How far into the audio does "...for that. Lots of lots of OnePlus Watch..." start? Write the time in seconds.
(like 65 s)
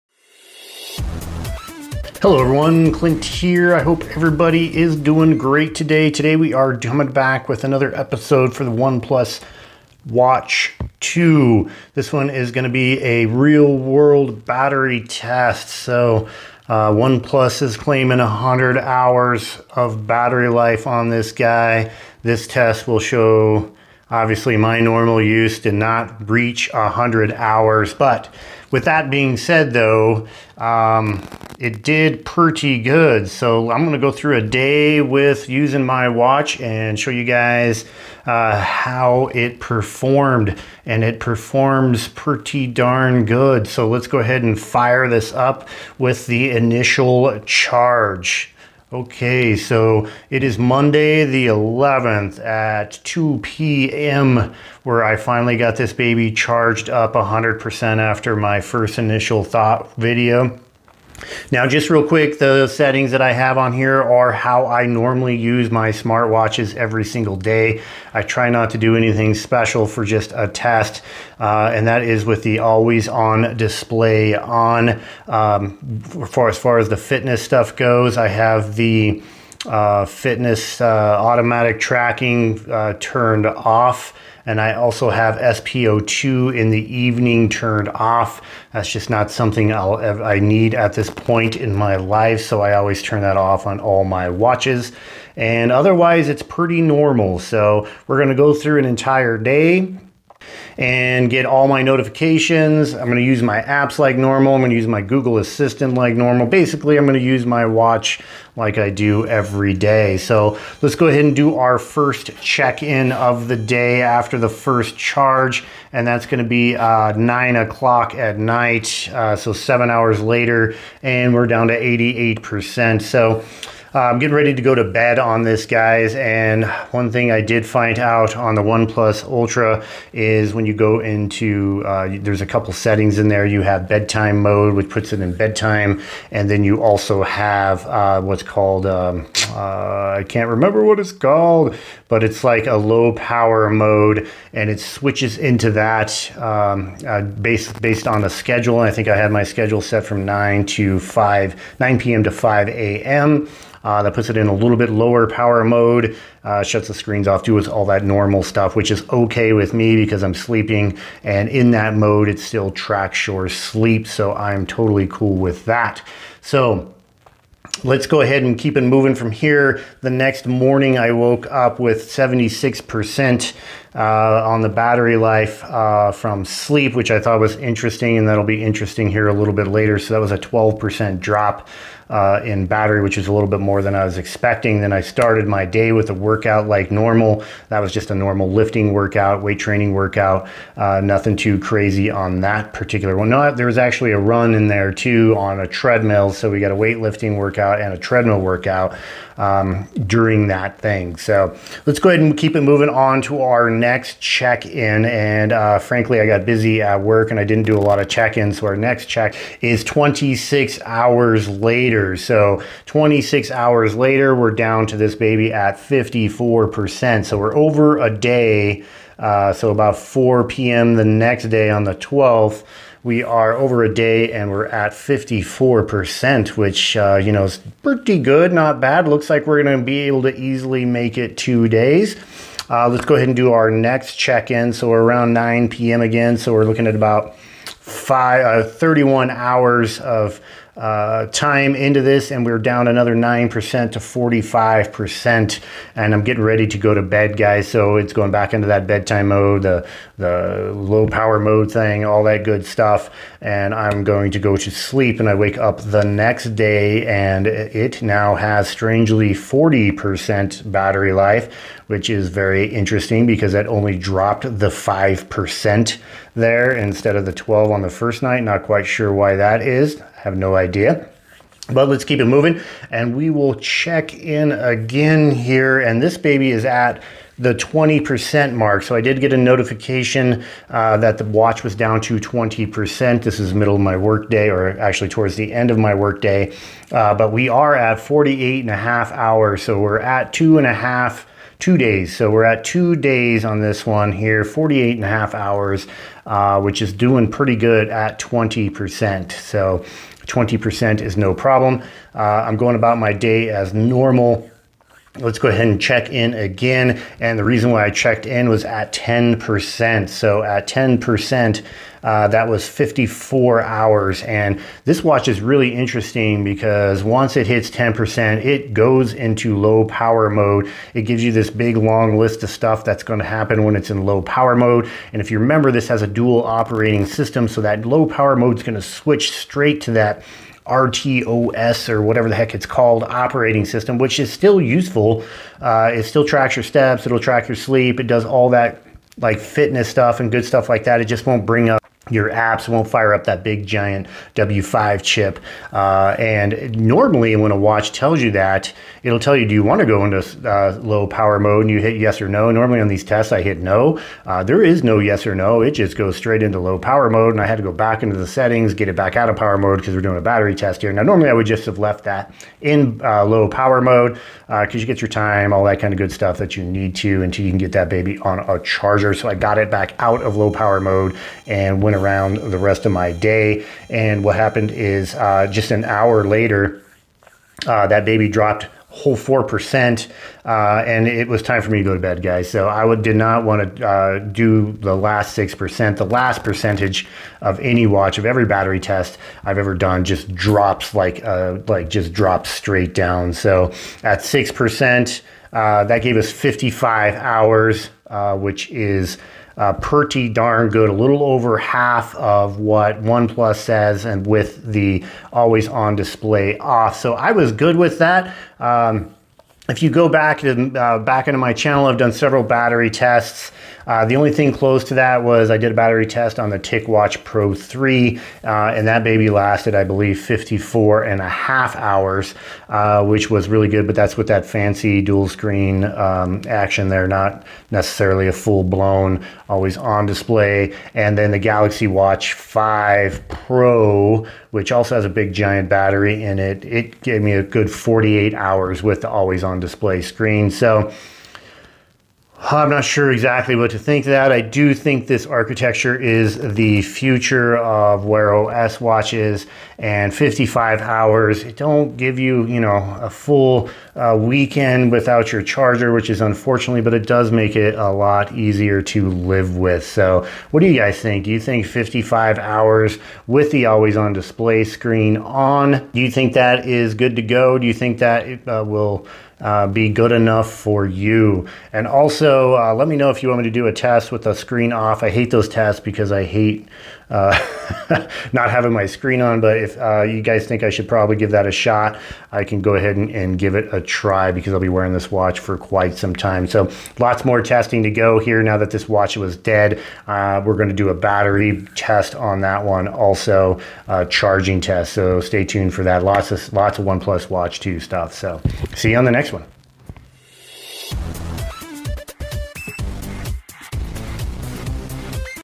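495 s.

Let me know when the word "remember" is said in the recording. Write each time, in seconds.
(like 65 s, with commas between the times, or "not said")
140 s, 325 s.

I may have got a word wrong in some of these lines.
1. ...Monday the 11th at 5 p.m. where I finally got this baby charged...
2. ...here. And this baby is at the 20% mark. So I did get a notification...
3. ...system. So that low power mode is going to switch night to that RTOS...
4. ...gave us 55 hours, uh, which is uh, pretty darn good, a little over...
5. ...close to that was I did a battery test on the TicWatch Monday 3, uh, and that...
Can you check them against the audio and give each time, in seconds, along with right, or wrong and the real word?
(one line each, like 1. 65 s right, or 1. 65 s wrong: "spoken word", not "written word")
1. 50 s wrong: "2", not "5"
2. 275 s right
3. 327 s wrong: "straight", not "night"
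4. 396 s right
5. 414 s wrong: "Pro", not "Monday".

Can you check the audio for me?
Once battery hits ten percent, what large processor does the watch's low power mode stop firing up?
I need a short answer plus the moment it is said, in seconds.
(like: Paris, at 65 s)
W5 chip, at 344 s.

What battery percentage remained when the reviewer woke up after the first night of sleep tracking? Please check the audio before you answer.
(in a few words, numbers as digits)
76%.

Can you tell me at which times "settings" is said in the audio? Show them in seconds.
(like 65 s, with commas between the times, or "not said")
62 s, 132 s, 358 s.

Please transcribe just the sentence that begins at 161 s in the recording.
And in that mode, it still tracks your sleep.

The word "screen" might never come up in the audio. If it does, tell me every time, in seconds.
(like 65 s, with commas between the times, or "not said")
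156 s, 425 s, 440 s, 464 s, 474 s, 478 s.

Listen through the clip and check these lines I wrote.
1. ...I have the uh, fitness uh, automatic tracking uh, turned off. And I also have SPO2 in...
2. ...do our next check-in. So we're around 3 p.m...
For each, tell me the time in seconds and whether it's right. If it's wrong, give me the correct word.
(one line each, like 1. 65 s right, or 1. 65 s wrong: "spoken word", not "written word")
1. 78 s right
2. 233 s wrong: "9", not "3".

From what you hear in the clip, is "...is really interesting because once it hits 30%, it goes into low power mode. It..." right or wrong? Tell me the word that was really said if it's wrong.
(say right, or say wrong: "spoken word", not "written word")
wrong: "10", not "30".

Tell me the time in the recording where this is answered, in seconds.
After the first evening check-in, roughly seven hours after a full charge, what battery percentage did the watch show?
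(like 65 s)
121 s.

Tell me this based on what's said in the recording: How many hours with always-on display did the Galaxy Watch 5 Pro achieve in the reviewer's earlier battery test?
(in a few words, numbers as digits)
48 hours.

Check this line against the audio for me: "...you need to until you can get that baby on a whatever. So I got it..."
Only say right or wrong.
wrong.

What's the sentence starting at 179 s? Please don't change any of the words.
So that was a 12% drop uh, in battery, which is a little bit more than I was expecting.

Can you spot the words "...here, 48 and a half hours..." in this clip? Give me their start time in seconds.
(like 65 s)
294 s.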